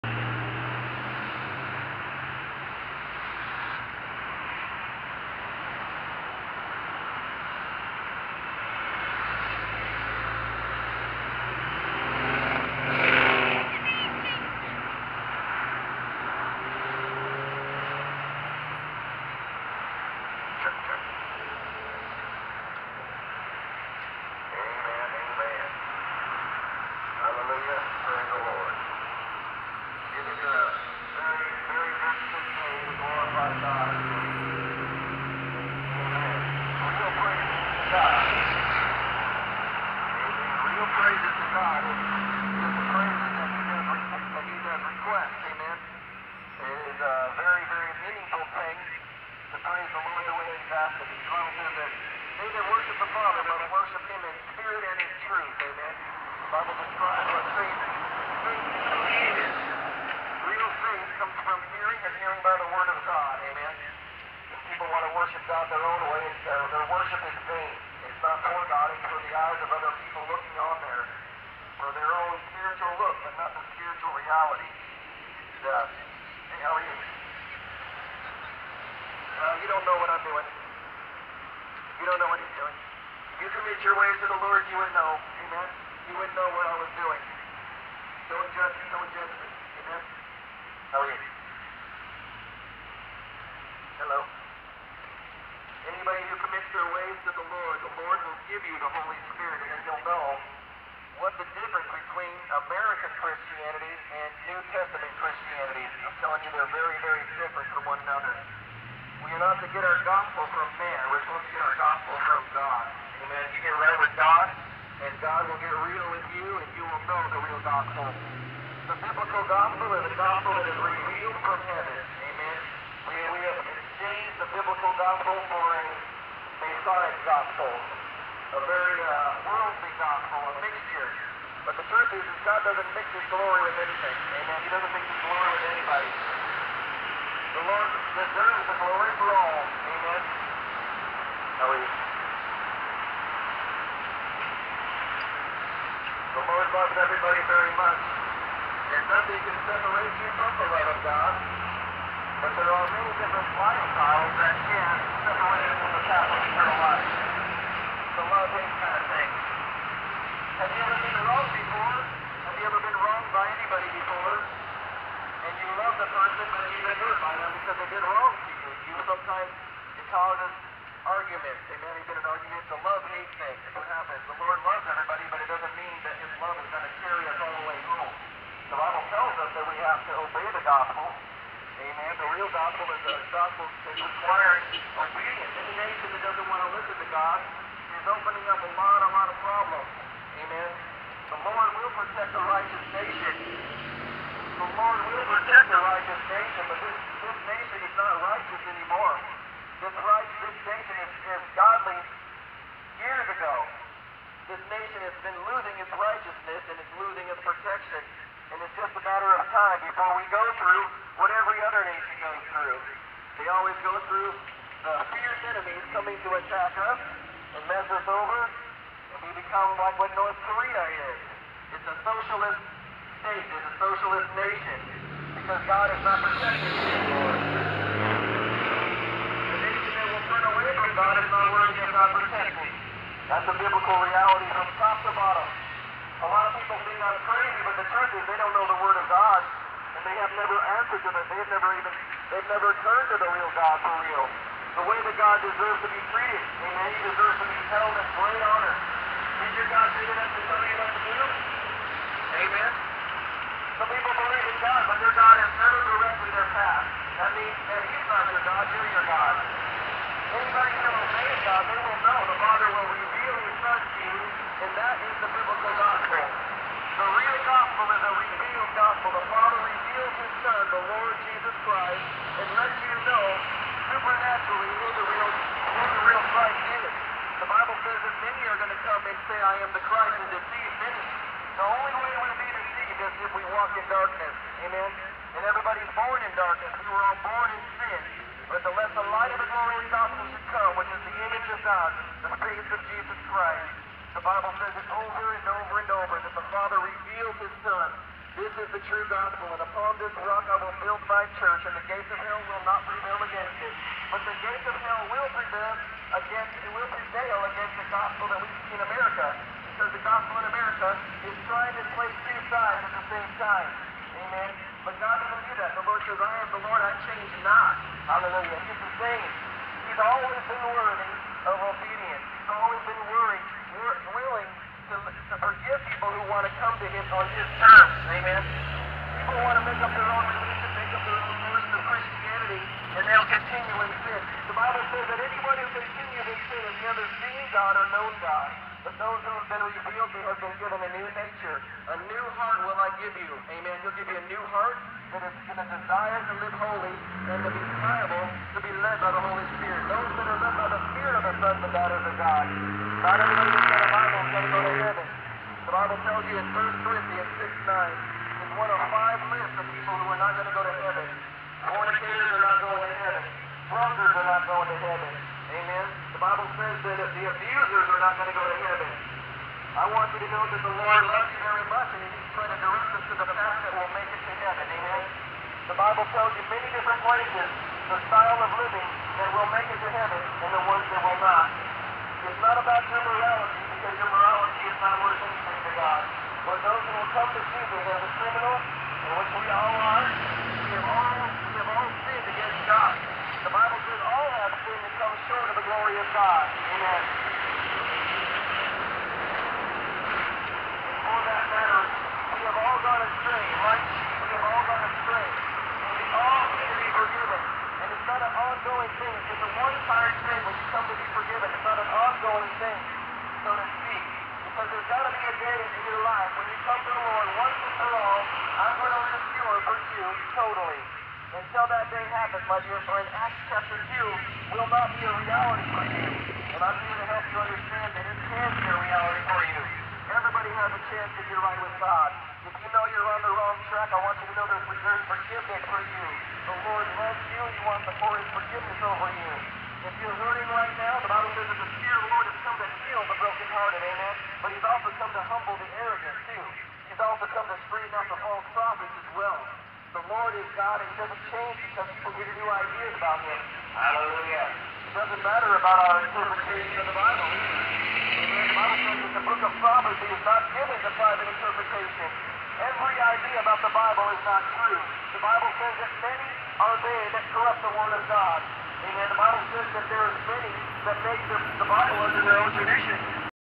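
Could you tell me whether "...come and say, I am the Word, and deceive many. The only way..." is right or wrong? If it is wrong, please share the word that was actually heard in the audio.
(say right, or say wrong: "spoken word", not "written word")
wrong: "Christ", not "Word".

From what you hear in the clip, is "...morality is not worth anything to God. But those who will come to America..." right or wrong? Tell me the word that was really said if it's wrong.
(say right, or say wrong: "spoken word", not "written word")
wrong: "Jesus", not "America".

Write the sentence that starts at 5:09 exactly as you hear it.
Because the gospel in America is trying to play two sides at the same time.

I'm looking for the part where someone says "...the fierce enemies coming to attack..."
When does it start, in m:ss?
3:34.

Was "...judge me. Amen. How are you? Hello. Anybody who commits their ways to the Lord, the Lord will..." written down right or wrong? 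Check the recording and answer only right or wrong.
right.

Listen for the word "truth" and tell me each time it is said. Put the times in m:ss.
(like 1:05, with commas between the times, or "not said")
0:55, 2:11, 3:57.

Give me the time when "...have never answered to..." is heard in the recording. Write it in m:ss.
4:00.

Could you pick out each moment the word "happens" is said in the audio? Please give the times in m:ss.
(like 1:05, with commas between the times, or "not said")
2:53, 7:02.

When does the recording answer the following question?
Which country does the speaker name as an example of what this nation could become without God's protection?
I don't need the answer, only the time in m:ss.
3:40.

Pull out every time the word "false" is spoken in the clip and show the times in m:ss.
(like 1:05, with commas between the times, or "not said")
7:28.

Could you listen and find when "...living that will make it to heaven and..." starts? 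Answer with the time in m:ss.
6:18.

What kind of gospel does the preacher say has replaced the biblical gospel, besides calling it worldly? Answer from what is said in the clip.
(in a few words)
Masonic gospel.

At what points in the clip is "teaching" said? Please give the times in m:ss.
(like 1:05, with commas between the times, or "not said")
not said.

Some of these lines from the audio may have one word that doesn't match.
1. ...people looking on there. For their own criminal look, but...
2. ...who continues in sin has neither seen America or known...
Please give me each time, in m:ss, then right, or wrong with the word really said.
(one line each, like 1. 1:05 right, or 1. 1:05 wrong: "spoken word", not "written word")
1. 1:10 wrong: "spiritual", not "criminal"
2. 5:35 wrong: "God", not "America".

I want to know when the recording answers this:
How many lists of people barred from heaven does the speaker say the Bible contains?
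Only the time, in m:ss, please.
5:58.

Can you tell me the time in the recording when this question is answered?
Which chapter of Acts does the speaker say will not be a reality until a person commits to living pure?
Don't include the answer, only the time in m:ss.
7:03.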